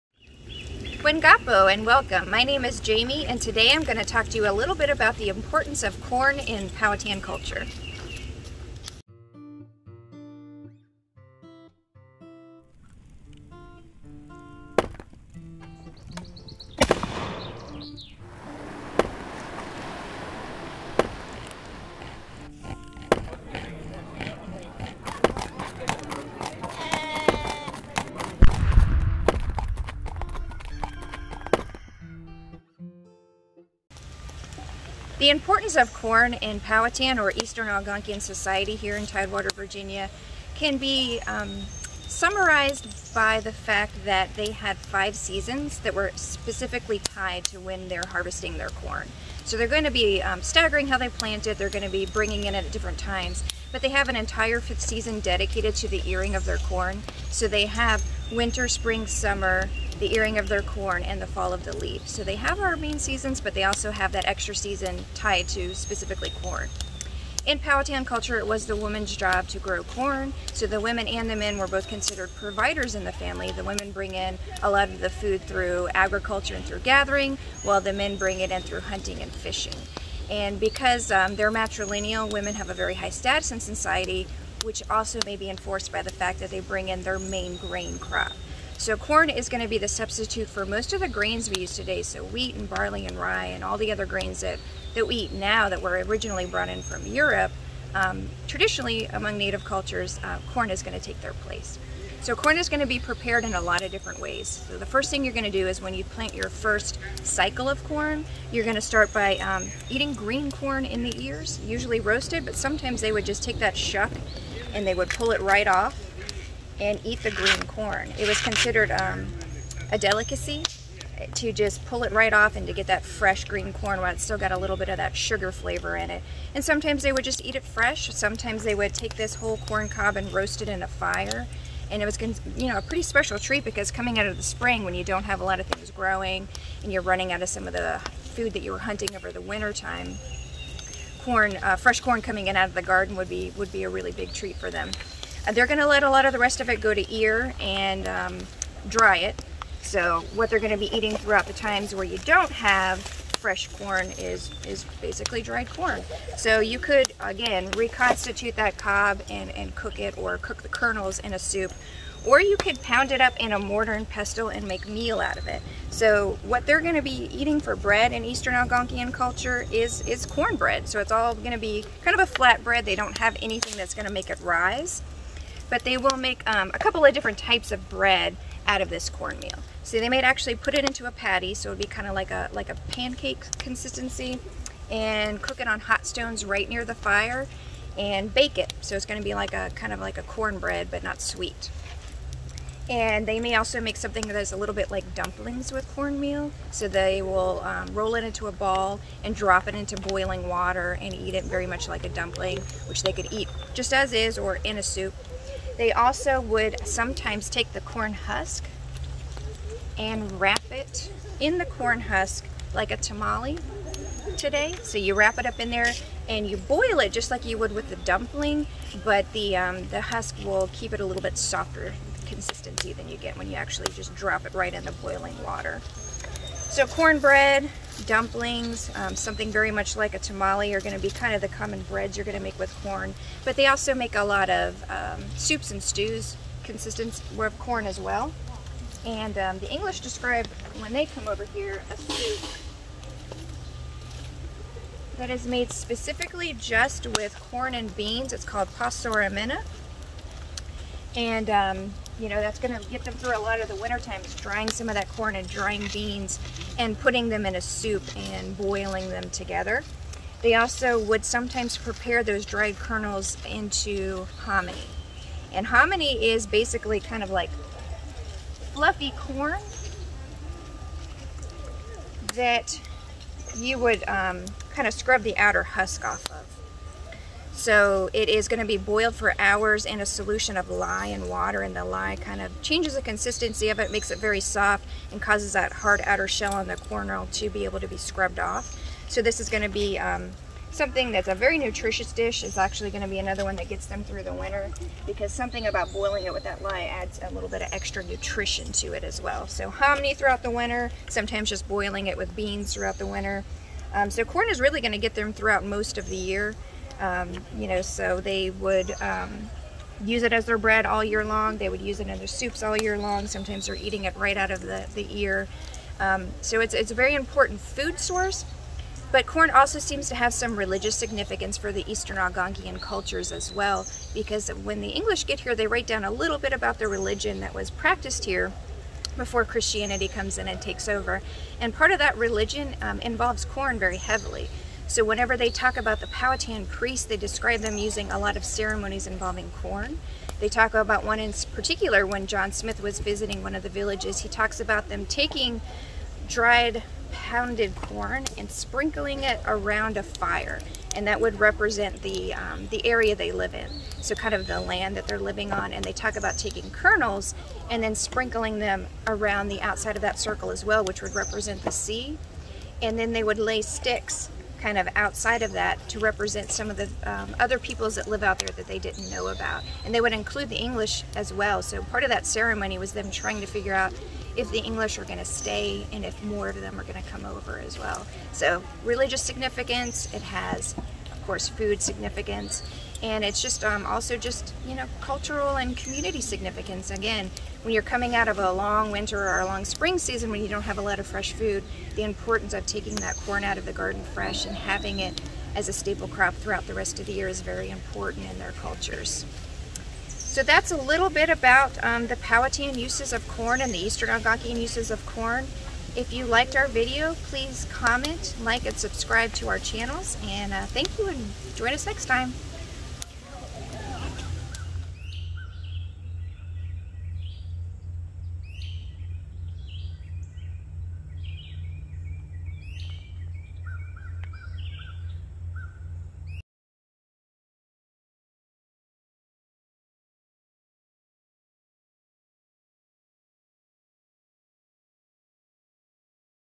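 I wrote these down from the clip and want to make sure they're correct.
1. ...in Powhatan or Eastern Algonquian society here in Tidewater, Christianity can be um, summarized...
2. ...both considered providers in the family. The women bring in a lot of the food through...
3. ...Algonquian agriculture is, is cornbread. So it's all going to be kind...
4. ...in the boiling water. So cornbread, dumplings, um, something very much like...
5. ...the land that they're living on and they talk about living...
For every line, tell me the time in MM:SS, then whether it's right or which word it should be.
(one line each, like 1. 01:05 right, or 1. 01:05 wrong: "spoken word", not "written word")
1. 00:36 wrong: "Virginia", not "Christianity"
2. 01:11 right
3. 02:48 wrong: "culture", not "agriculture"
4. 03:44 right
5. 05:54 wrong: "taking", not "living".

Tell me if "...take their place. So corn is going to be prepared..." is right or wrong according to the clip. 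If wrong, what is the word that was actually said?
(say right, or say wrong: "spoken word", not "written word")
right.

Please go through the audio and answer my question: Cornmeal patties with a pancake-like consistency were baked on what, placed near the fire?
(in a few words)
Hot stones.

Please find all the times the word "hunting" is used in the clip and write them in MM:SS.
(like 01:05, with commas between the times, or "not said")
01:18, 02:18.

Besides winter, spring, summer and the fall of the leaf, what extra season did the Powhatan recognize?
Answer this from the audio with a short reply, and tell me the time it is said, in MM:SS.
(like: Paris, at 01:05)
The earing of their corn, at 01:00.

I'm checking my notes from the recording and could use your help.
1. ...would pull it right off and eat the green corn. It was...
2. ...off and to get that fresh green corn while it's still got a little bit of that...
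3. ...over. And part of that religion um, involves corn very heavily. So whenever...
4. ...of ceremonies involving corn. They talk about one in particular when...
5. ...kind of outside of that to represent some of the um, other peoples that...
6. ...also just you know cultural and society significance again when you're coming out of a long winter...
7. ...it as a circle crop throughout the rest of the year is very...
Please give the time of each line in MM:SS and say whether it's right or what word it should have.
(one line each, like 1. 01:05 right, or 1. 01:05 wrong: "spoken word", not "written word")
1. 01:54 right
2. 02:02 right
3. 05:30 right
4. 05:38 right
5. 06:04 right
6. 06:23 wrong: "community", not "society"
7. 06:34 wrong: "staple", not "circle".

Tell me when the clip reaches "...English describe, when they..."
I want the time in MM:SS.
03:59.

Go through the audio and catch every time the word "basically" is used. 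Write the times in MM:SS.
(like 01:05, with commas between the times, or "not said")
02:35, 04:26.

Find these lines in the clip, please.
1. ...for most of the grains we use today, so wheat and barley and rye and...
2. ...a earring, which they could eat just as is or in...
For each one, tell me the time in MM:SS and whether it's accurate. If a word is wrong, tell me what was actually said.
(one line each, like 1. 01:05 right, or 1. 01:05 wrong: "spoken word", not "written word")
1. 01:30 right
2. 03:22 wrong: "dumpling", not "earring".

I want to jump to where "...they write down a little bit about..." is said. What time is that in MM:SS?
05:25.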